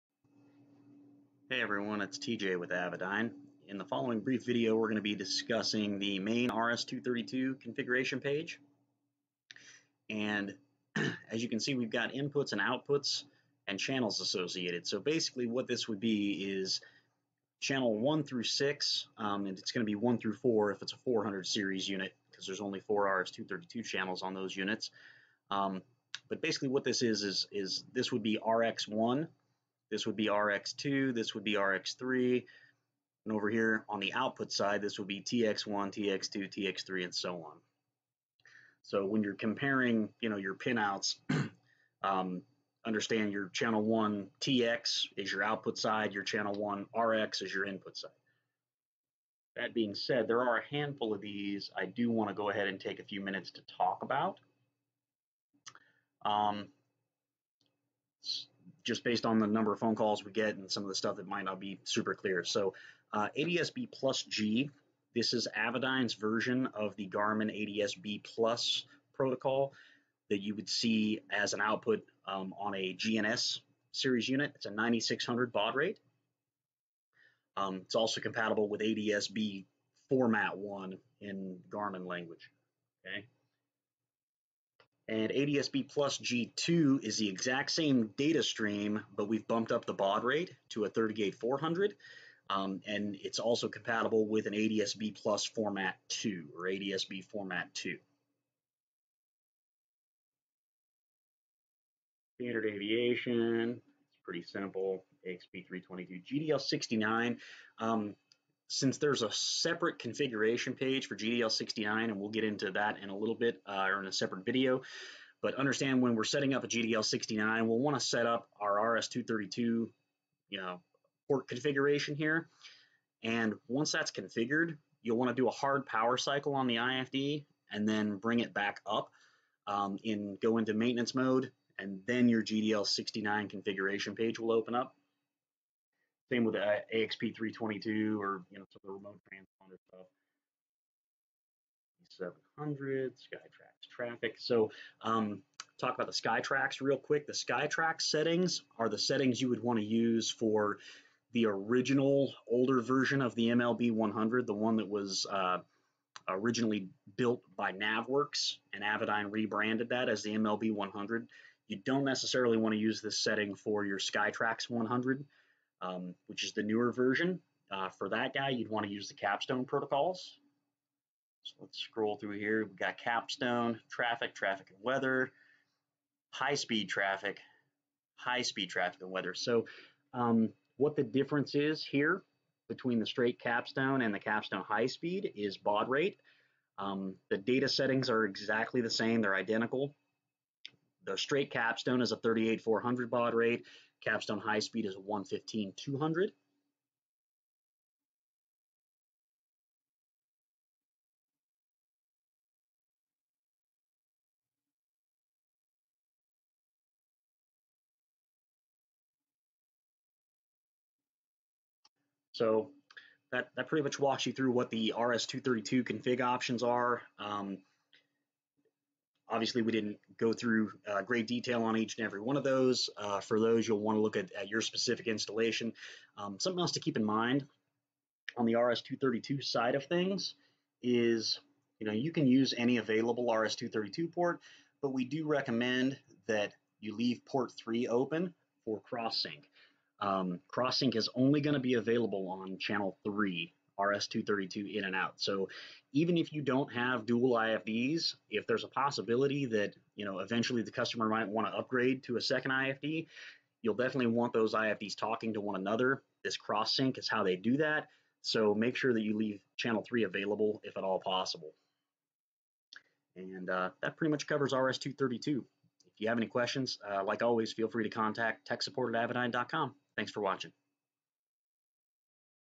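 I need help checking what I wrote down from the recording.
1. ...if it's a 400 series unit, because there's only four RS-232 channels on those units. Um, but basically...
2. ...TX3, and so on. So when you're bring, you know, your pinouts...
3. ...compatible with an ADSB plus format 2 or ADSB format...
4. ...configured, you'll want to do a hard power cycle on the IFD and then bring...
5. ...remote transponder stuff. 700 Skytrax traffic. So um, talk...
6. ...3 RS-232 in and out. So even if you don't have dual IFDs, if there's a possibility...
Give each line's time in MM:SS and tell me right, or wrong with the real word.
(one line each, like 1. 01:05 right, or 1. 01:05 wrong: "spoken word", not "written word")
1. 00:20 right
2. 00:36 wrong: "comparing", not "bring"
3. 01:33 right
4. 02:04 right
5. 02:18 right
6. 04:03 right.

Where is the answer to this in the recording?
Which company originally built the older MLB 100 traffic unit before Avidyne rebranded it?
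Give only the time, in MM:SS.
02:37.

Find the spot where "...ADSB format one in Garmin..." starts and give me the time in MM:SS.
01:18.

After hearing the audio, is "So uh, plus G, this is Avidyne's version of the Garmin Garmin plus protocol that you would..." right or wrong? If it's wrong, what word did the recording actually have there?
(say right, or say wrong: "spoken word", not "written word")
wrong: "ADSB", not "Garmin".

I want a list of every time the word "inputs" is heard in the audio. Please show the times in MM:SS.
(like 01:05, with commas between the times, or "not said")
00:12, 00:47.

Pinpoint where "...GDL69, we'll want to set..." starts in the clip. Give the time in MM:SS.
01:56.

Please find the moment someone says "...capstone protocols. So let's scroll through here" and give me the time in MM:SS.
02:49.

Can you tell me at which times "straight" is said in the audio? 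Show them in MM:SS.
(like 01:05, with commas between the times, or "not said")
03:03, 03:11.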